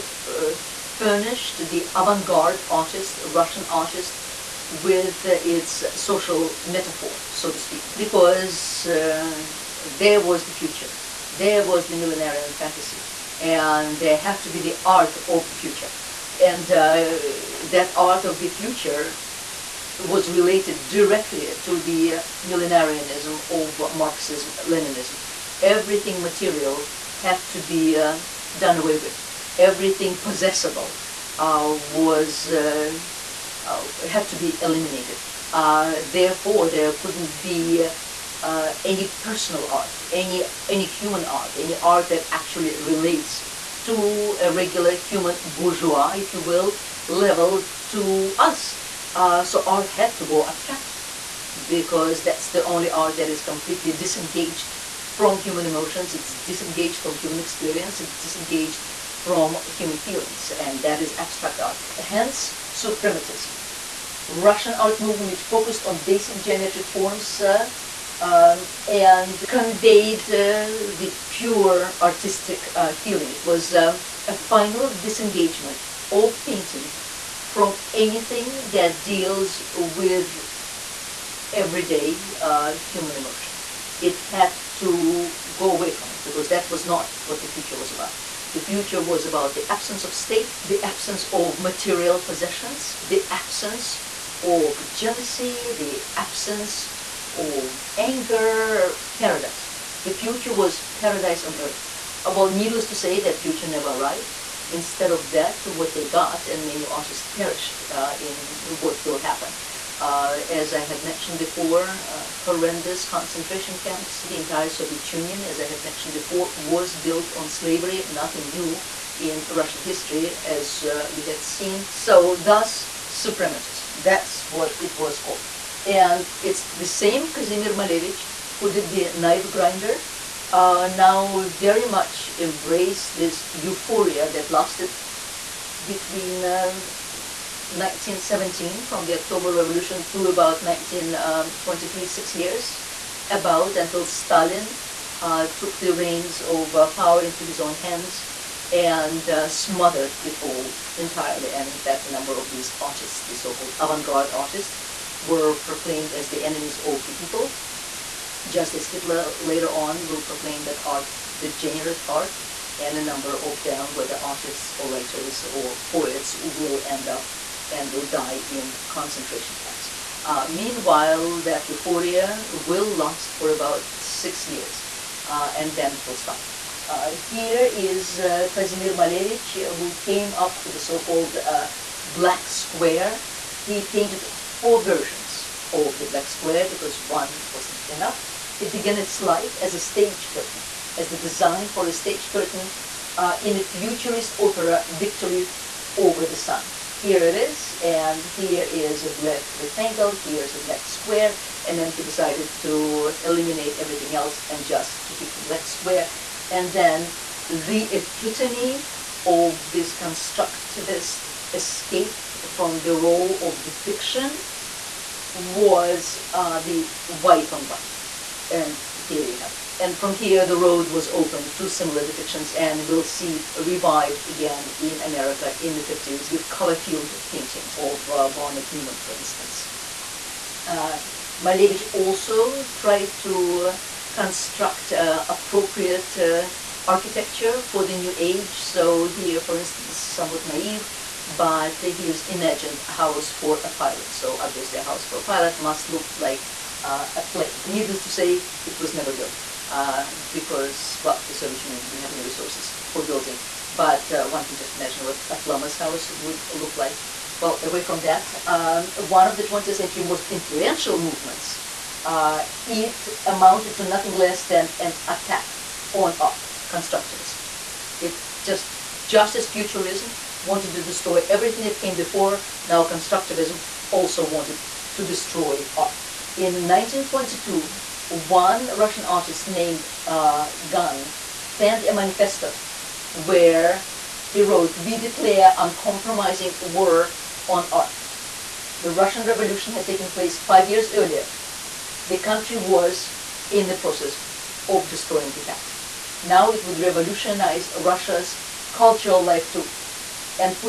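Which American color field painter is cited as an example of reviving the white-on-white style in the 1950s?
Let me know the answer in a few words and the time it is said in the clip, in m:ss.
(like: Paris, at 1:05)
Barnett Newman, at 3:48.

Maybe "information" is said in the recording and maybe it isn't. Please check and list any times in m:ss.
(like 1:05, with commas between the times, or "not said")
not said.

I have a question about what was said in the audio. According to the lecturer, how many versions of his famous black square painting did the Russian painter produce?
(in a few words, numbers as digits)
4.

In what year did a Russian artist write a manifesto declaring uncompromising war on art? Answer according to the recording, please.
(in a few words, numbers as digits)
1922.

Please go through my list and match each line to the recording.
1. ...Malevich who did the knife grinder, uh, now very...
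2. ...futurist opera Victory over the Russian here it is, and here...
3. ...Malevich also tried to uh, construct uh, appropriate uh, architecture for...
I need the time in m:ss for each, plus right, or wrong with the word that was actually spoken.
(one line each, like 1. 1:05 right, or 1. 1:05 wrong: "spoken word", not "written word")
1. 2:07 right
2. 3:13 wrong: "Sun", not "Russian"
3. 3:51 right.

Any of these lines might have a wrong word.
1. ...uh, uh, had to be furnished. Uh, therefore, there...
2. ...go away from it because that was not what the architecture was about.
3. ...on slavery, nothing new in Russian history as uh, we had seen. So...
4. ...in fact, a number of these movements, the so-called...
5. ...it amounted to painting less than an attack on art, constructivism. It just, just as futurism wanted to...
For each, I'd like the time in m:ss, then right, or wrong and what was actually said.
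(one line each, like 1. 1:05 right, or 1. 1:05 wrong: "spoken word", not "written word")
1. 0:32 wrong: "eliminated", not "furnished"
2. 1:25 wrong: "future", not "architecture"
3. 1:57 right
4. 2:31 wrong: "artists", not "movements"
5. 4:22 wrong: "nothing", not "painting".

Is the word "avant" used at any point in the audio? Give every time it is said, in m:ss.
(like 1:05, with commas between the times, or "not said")
0:01, 2:33.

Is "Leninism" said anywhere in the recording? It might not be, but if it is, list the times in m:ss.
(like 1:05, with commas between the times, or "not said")
0:24.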